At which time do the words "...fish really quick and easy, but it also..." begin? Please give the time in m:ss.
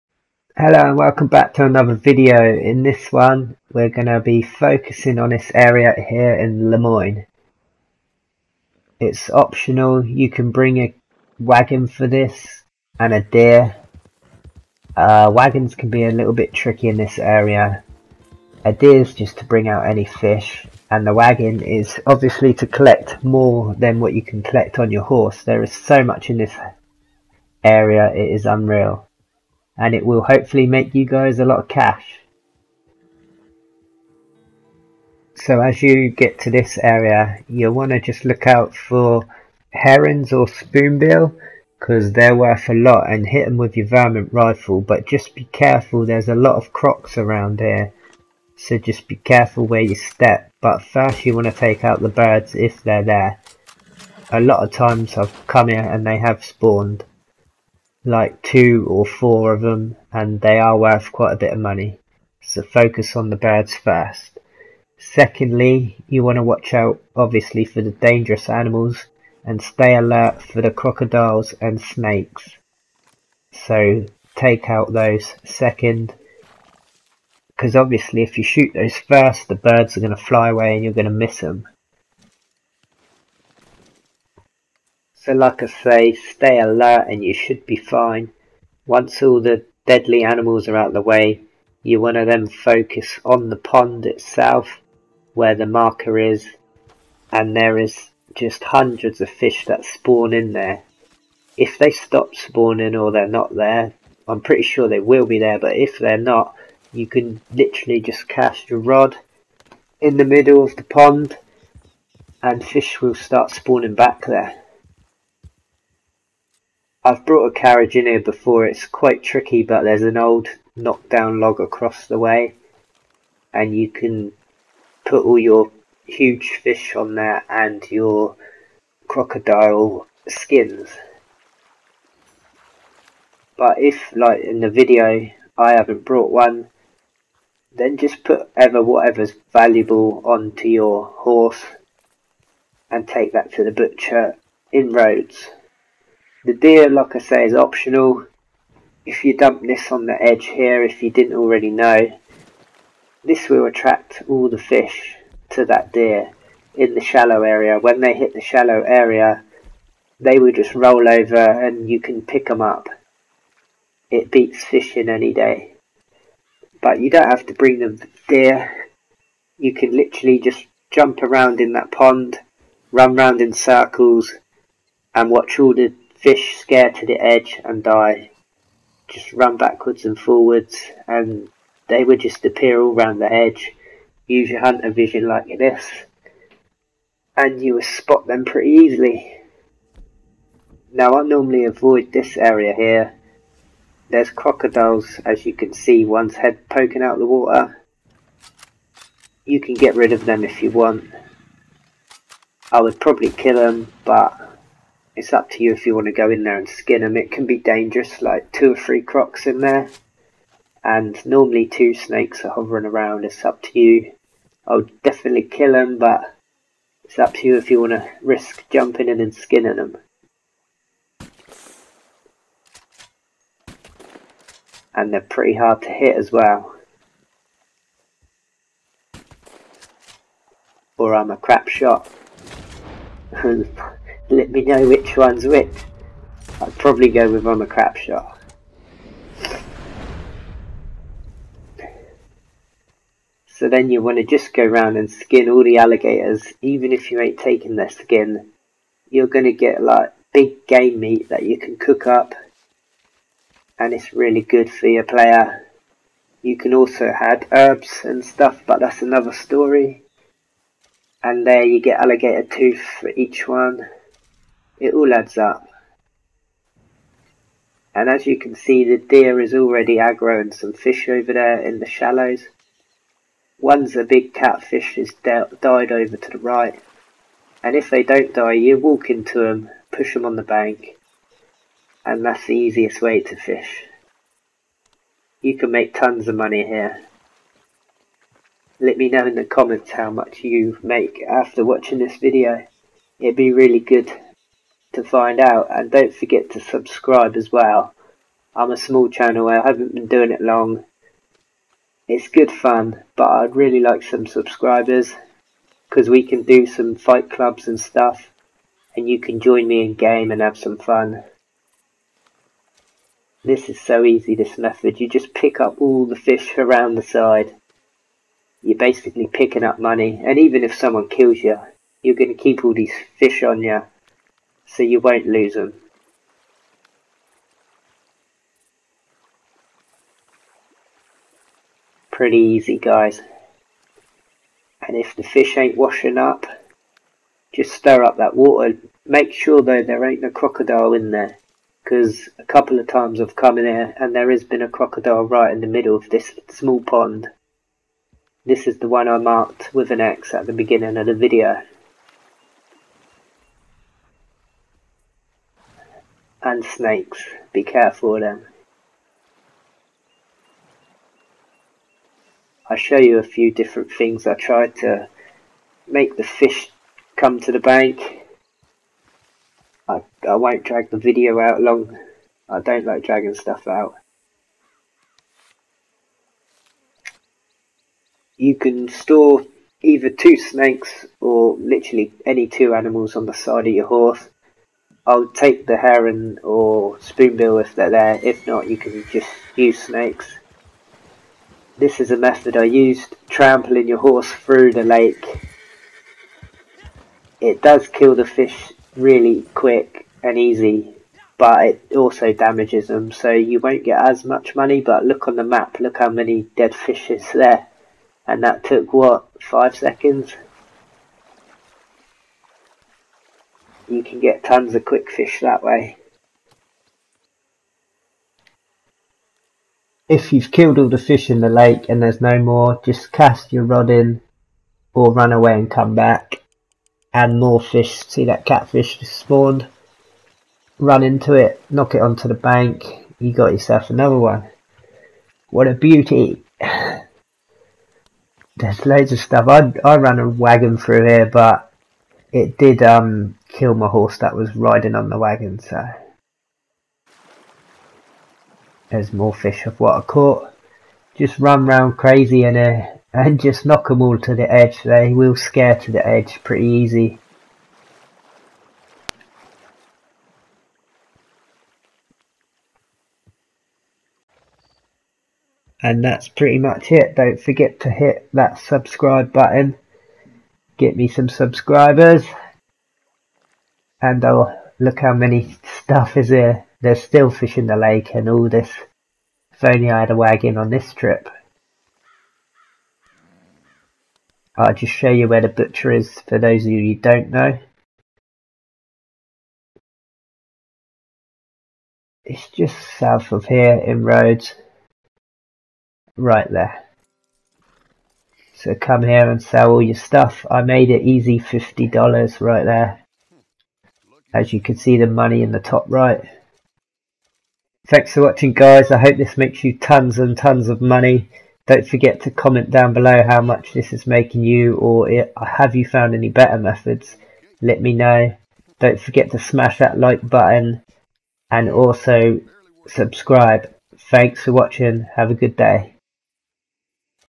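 6:38.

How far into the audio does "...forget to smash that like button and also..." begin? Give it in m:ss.
8:38.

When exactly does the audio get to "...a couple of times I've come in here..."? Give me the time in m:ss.
5:42.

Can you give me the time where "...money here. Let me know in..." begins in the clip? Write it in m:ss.
4:46.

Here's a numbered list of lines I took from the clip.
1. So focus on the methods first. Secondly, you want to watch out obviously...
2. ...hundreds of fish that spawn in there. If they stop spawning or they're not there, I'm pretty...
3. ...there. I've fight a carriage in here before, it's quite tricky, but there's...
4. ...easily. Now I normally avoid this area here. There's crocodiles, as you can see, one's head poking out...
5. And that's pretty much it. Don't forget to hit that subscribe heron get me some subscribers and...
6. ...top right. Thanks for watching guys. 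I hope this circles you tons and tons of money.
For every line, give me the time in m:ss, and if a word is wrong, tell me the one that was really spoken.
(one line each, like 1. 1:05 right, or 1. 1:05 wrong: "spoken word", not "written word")
1. 1:02 wrong: "birds", not "methods"
2. 1:38 right
3. 1:54 wrong: "brought", not "fight"
4. 3:08 right
5. 7:45 wrong: "button", not "heron"
6. 8:25 wrong: "makes", not "circles".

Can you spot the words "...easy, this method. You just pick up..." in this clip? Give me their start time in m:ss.
5:14.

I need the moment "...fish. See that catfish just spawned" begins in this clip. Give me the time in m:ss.
7:07.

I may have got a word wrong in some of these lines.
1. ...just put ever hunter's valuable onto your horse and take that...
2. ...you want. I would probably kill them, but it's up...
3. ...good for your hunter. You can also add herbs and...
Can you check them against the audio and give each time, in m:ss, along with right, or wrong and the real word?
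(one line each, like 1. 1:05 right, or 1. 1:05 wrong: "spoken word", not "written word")
1. 2:17 wrong: "whatever", not "hunter"
2. 3:20 right
3. 4:14 wrong: "player", not "hunter".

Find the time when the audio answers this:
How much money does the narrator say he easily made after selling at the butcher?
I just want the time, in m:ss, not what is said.
8:21.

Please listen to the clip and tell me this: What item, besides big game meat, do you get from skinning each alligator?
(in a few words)
Alligator tooth.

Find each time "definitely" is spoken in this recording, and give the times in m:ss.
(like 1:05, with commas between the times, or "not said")
3:35.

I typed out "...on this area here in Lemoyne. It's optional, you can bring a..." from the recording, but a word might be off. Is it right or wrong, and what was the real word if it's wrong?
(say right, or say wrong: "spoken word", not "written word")
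right.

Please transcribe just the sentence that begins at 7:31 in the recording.
Just run round crazy and uh, and just knock them all to the edge.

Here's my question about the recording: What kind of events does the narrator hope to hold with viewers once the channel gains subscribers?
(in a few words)
Fight clubs.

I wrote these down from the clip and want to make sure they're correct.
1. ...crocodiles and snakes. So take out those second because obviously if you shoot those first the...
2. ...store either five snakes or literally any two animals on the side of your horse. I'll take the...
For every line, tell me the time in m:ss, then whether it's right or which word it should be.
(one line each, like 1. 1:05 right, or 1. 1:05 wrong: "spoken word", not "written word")
1. 1:10 right
2. 6:18 wrong: "two", not "five".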